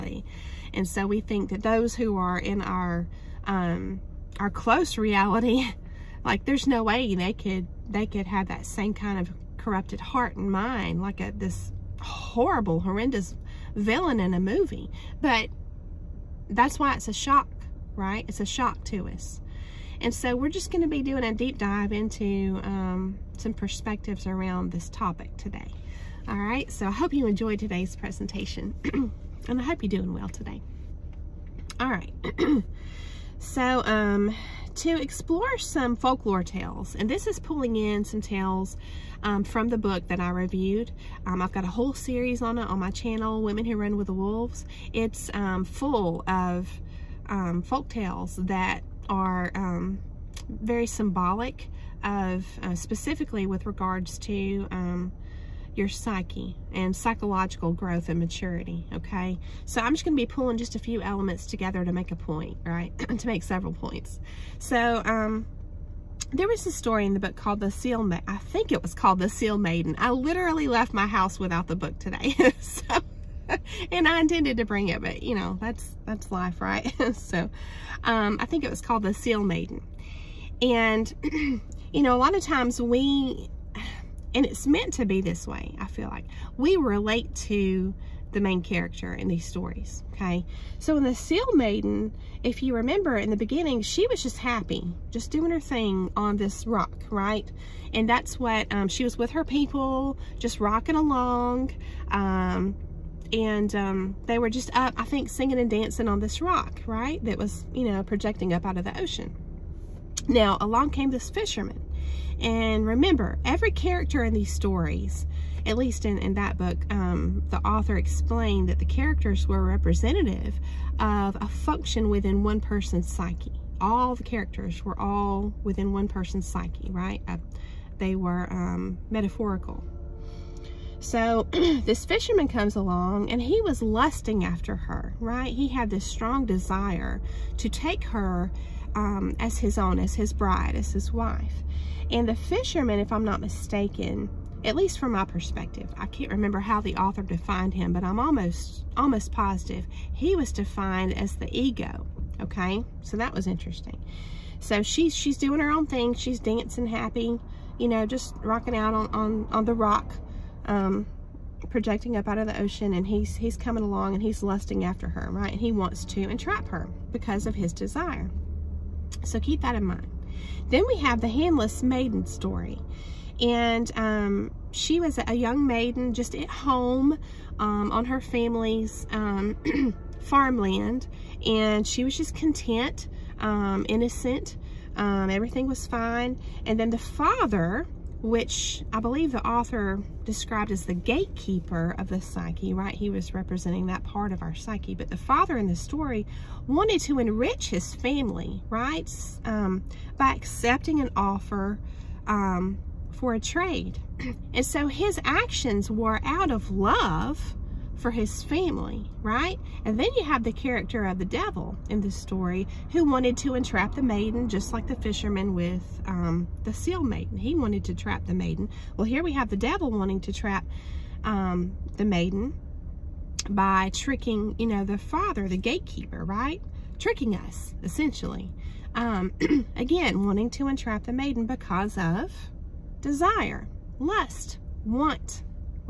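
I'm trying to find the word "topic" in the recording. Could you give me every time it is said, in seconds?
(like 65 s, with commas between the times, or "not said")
24 s.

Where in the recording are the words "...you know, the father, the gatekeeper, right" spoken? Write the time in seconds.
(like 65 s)
224 s.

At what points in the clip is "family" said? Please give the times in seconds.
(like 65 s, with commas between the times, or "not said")
178 s, 197 s, 208 s.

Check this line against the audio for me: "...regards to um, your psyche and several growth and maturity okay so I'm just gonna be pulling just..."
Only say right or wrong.
wrong.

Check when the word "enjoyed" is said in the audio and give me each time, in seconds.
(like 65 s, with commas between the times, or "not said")
27 s.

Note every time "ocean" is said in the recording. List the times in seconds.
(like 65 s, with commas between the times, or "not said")
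108 s, 162 s.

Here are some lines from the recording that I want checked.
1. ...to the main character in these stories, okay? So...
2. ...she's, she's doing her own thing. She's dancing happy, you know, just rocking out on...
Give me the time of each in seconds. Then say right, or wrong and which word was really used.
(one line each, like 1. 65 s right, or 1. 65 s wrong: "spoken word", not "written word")
1. 87 s right
2. 154 s right.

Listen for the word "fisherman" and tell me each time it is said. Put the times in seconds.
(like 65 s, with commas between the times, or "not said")
111 s, 132 s, 142 s, 214 s.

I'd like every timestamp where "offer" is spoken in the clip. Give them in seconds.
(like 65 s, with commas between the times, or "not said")
201 s.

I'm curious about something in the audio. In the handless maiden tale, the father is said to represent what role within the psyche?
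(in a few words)
gatekeeper of the psyche.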